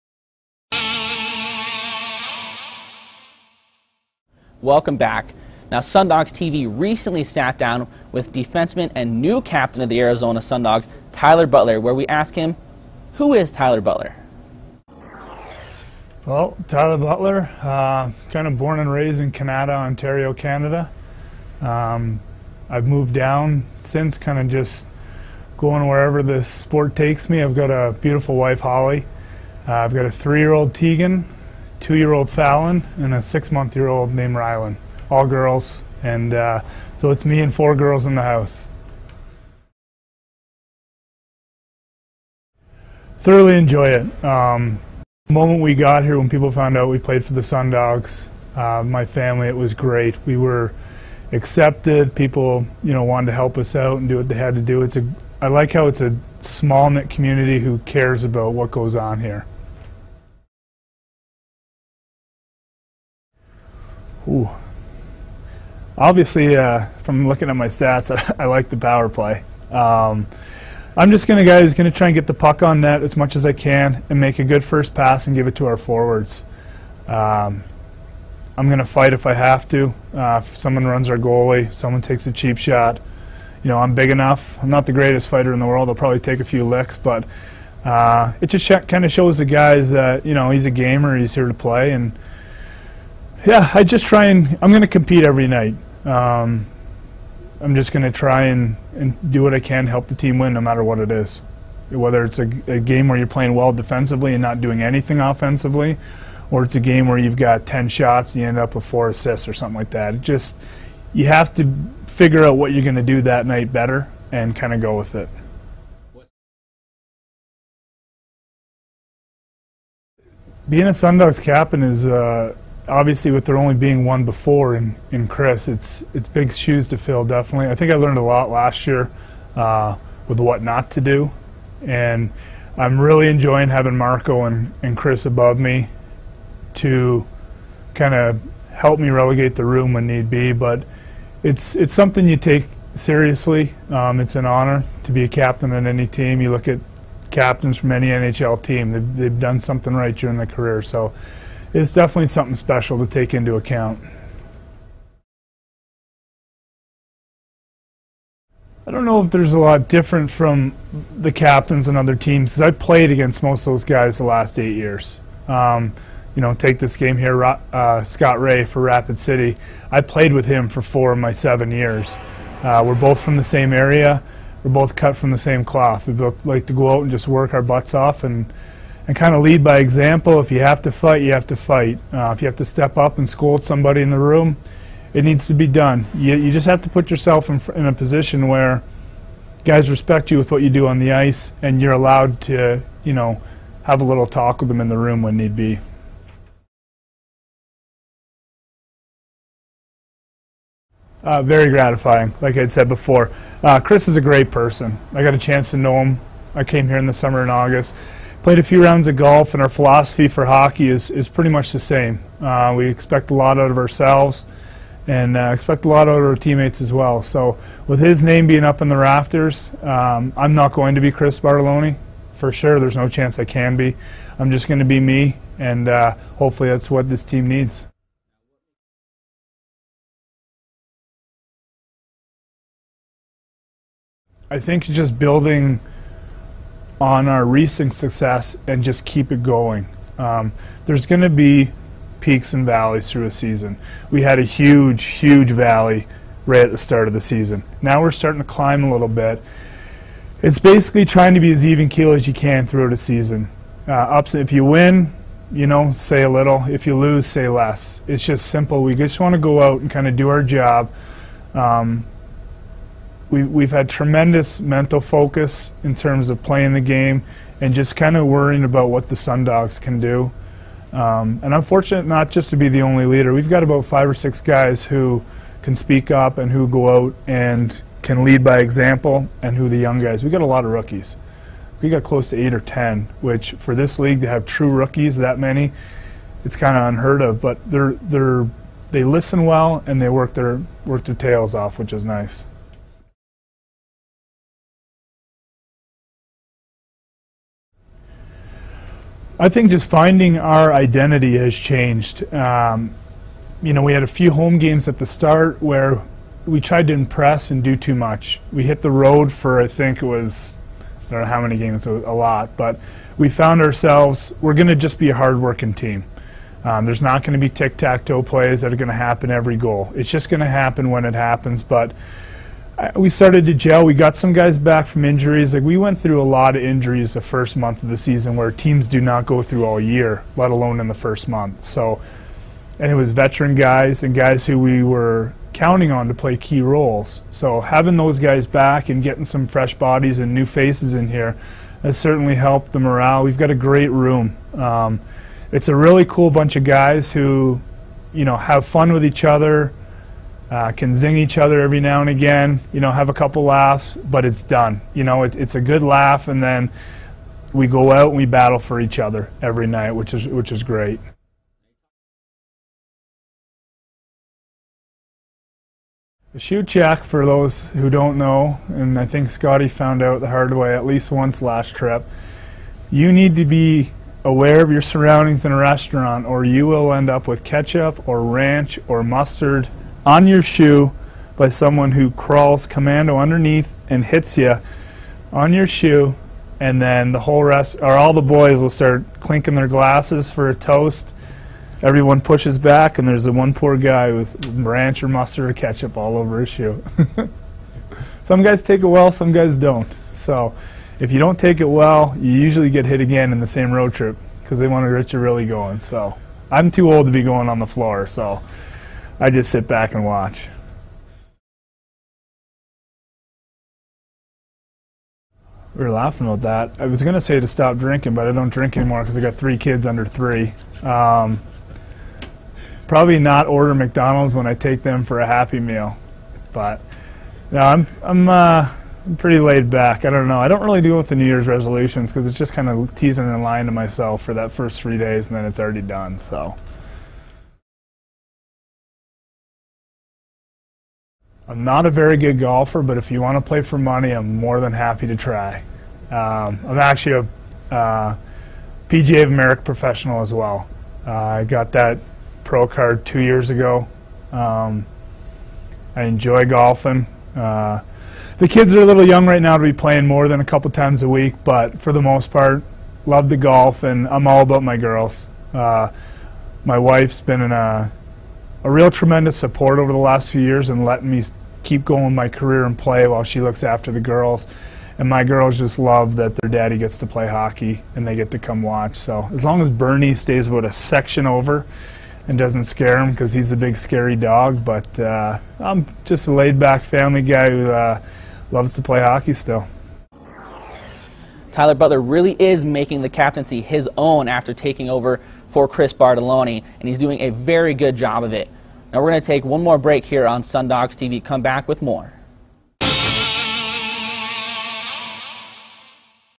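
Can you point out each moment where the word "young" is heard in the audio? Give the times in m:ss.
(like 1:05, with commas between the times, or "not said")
4:39, 7:39.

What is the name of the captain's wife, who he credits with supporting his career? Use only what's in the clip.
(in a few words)
Holly.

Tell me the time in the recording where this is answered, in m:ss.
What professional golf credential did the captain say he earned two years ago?
7:28.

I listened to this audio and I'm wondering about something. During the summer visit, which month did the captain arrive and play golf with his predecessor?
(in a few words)
August.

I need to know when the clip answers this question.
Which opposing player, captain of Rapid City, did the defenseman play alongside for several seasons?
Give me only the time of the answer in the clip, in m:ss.
2:48.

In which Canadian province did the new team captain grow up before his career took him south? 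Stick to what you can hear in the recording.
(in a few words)
Ontario.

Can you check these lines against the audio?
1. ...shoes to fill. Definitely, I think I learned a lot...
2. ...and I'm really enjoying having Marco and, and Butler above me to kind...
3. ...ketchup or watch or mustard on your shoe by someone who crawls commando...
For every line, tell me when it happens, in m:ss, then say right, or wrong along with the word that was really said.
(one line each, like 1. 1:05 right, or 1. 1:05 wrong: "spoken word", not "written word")
1. 2:06 right
2. 2:11 wrong: "Chris", not "Butler"
3. 6:17 wrong: "ranch", not "watch".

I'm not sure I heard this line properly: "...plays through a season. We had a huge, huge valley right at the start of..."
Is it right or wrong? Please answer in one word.
wrong.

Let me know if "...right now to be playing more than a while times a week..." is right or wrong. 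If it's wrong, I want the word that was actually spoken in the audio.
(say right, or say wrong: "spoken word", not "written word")
wrong: "couple", not "while".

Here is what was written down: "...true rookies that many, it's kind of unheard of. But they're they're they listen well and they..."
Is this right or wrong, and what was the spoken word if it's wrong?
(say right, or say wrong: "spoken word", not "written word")
right.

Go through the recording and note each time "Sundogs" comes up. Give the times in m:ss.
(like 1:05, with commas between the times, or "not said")
0:05, 0:10, 0:47, 2:00, 4:29, 8:20.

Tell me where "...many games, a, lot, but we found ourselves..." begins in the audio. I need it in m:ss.
5:11.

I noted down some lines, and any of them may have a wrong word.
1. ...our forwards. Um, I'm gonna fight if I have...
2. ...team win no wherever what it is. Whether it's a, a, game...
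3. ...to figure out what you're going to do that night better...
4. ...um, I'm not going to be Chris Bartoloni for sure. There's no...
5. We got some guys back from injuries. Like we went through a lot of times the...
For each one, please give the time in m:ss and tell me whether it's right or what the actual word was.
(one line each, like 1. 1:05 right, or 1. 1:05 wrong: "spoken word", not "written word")
1. 1:15 right
2. 1:40 wrong: "matter", not "wherever"
3. 1:51 right
4. 3:39 right
5. 5:23 wrong: "injuries", not "times".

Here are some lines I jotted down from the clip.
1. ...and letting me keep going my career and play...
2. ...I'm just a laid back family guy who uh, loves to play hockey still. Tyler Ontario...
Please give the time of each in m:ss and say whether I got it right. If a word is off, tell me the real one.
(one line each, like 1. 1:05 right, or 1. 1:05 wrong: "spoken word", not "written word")
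1. 7:50 right
2. 8:05 wrong: "Butler", not "Ontario".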